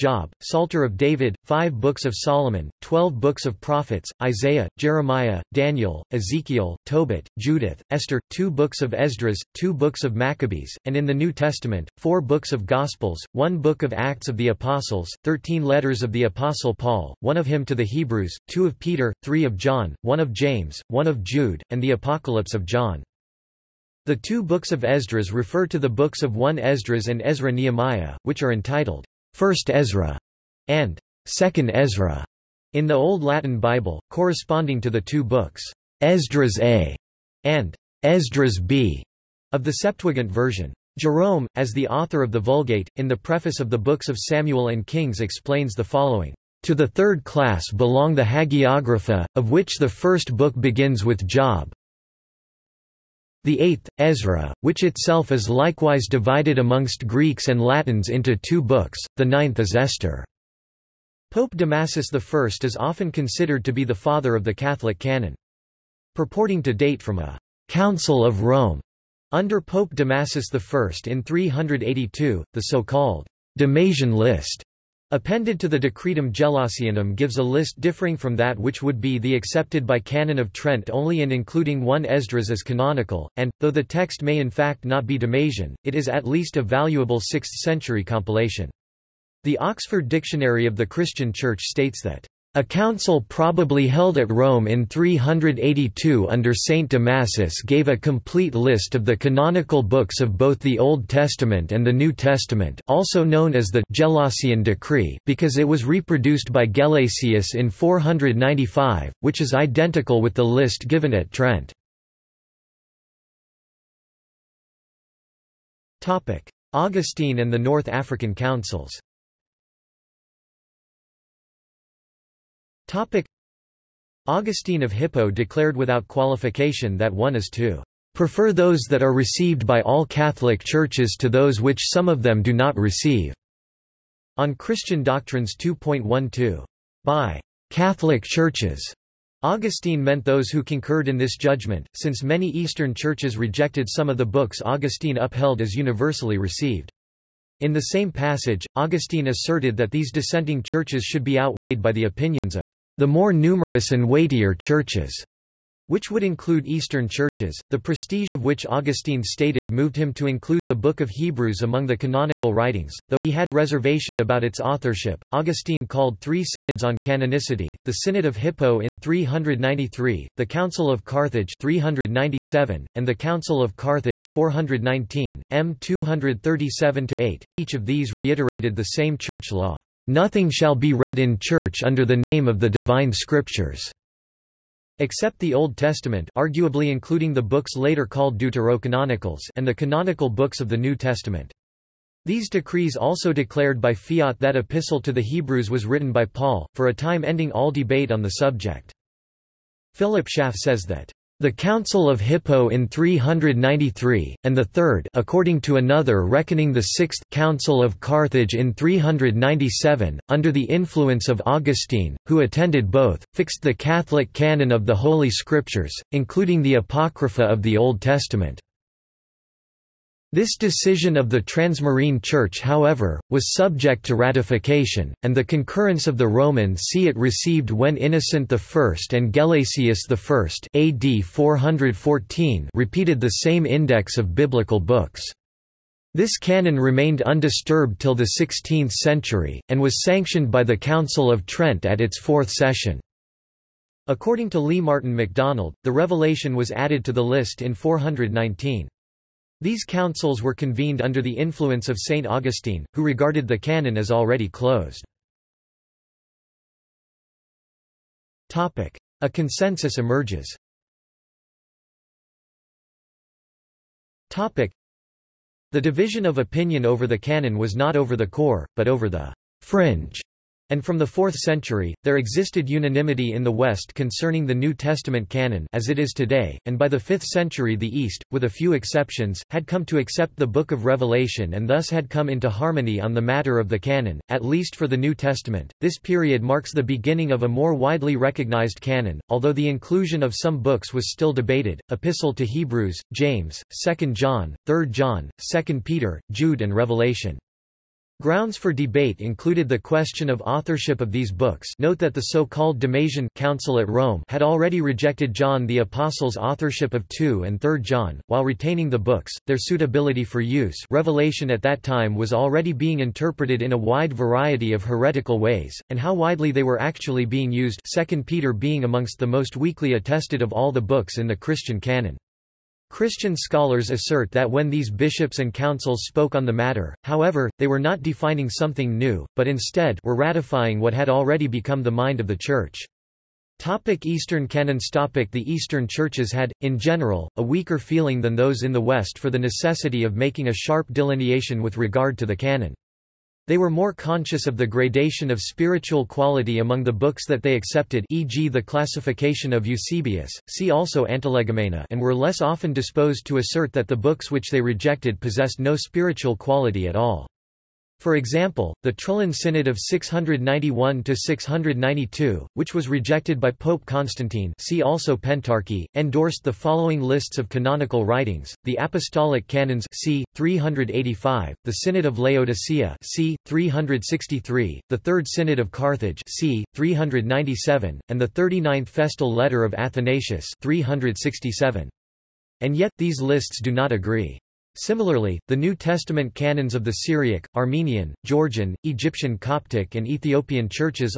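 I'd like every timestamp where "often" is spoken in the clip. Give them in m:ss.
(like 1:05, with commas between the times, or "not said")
1:02, 5:52.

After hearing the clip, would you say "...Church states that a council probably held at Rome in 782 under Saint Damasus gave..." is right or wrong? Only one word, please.
wrong.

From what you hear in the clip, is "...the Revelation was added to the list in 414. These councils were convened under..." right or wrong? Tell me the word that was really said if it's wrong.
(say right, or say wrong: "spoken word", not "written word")
wrong: "419", not "414".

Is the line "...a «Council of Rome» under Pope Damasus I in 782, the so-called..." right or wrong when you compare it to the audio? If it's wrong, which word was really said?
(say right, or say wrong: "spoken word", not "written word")
wrong: "382", not "782".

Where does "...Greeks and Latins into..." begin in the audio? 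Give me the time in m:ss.
0:57.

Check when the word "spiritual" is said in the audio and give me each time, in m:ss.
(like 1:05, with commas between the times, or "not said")
5:45, 5:55.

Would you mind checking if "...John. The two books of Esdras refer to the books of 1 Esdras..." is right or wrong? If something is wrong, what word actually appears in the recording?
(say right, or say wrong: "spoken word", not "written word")
right.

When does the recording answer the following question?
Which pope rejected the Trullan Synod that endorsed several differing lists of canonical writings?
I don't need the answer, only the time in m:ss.
6:03.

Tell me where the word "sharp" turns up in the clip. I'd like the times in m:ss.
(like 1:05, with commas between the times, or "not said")
5:40.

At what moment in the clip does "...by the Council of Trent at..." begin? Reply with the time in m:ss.
4:00.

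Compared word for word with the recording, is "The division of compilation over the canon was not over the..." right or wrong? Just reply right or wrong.
wrong.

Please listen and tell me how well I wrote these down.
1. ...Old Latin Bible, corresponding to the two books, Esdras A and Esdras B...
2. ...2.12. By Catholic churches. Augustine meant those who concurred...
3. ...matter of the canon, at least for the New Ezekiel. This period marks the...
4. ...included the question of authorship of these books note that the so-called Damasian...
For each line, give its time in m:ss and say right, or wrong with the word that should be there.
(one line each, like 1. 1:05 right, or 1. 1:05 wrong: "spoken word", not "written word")
1. 0:32 right
2. 2:15 right
3. 4:43 wrong: "Testament", not "Ezekiel"
4. 4:59 right.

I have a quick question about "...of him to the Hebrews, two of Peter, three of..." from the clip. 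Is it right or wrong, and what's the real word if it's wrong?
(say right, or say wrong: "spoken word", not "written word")
right.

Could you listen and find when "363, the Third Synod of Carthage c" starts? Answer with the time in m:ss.
6:13.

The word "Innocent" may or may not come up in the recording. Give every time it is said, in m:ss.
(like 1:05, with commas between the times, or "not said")
3:47.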